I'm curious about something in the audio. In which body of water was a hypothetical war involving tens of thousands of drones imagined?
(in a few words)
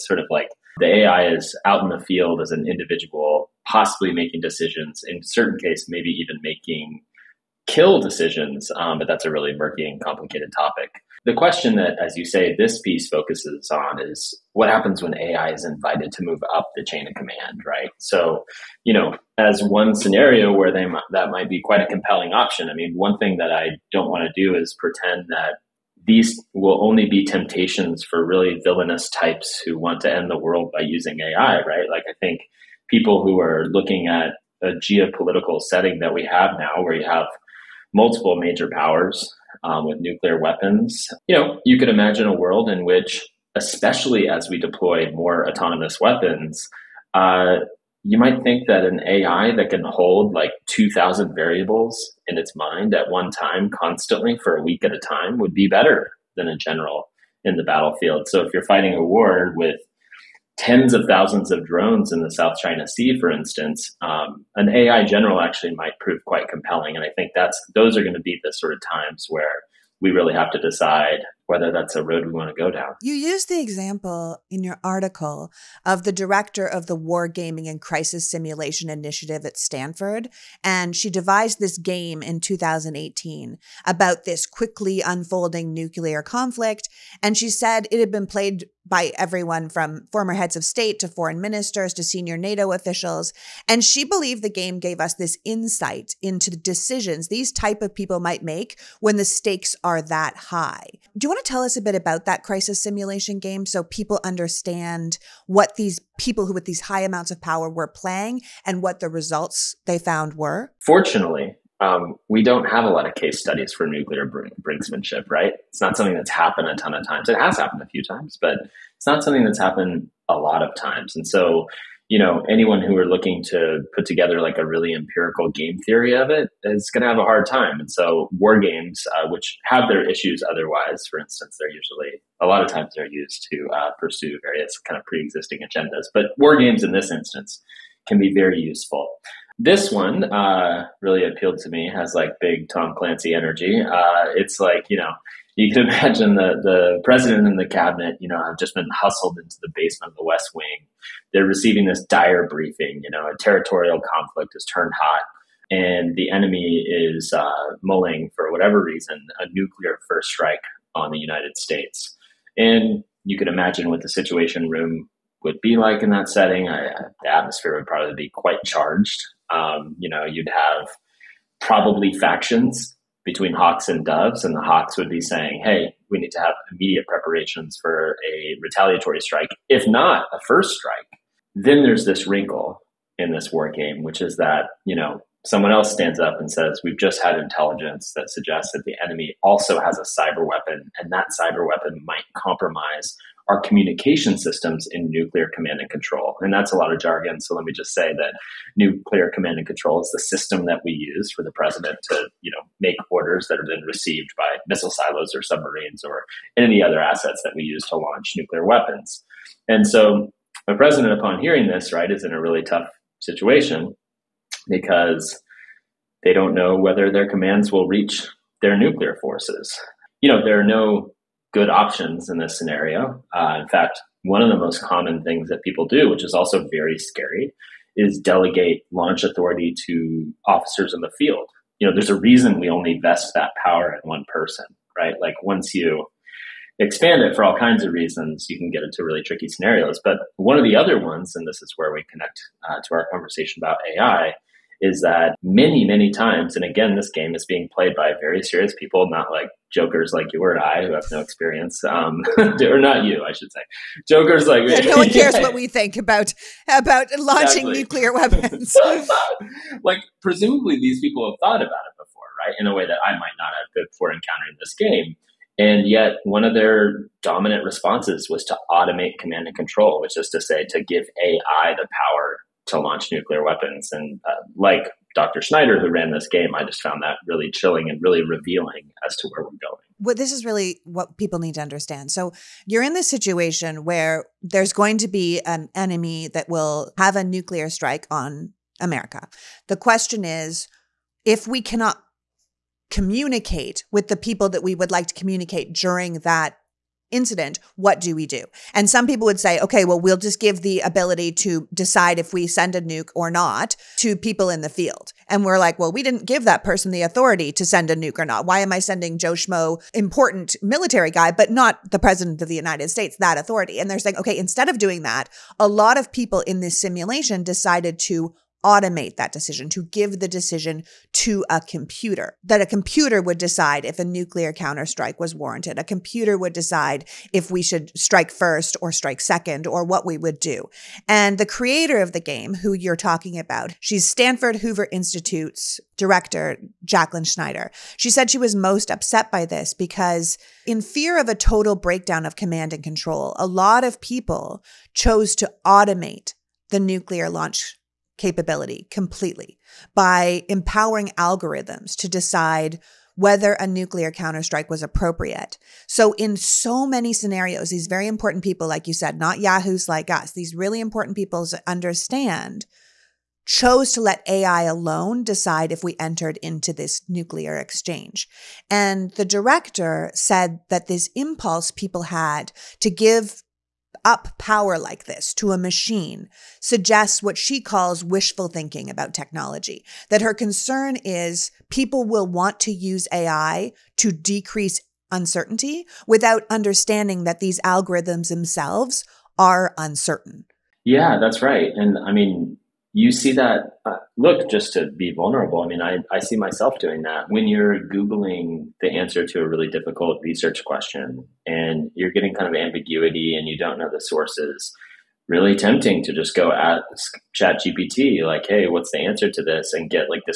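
South China Sea.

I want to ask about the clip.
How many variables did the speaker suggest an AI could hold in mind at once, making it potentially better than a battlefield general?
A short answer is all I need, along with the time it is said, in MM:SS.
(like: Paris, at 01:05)
2,000, at 00:50.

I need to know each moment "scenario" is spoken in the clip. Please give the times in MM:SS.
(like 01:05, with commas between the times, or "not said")
00:19, 03:42, 03:59, 05:57.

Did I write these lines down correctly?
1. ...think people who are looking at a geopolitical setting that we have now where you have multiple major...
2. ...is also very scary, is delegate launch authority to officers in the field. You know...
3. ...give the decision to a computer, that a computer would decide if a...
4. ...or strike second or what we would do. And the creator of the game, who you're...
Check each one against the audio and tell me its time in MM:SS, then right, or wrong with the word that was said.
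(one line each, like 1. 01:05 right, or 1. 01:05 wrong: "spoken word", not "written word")
1. 00:32 right
2. 03:46 right
3. 05:19 right
4. 05:28 right.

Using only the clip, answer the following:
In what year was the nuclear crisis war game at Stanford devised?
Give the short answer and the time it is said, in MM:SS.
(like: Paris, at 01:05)
2018, at 01:22.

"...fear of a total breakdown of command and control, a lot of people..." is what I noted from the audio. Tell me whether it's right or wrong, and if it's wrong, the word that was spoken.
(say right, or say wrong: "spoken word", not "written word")
right.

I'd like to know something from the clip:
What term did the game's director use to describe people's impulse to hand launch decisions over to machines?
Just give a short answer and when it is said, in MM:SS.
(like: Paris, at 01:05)
wishful thinking, at 06:18.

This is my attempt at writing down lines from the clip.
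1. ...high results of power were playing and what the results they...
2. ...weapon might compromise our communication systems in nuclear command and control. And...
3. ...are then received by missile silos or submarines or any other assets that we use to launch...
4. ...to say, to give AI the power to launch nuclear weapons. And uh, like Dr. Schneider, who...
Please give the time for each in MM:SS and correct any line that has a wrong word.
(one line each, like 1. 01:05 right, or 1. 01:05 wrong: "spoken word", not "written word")
1. 01:46 wrong: "amounts", not "results"
2. 03:11 right
3. 03:23 right
4. 04:30 right.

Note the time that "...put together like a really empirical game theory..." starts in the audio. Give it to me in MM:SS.
02:03.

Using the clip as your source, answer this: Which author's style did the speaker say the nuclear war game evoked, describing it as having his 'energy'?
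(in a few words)
Tom Clancy.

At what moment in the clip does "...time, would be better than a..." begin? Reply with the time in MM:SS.
00:54.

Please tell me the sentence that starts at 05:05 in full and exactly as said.
And we're like, well, we didn't give that person the authority to send a nuke or not.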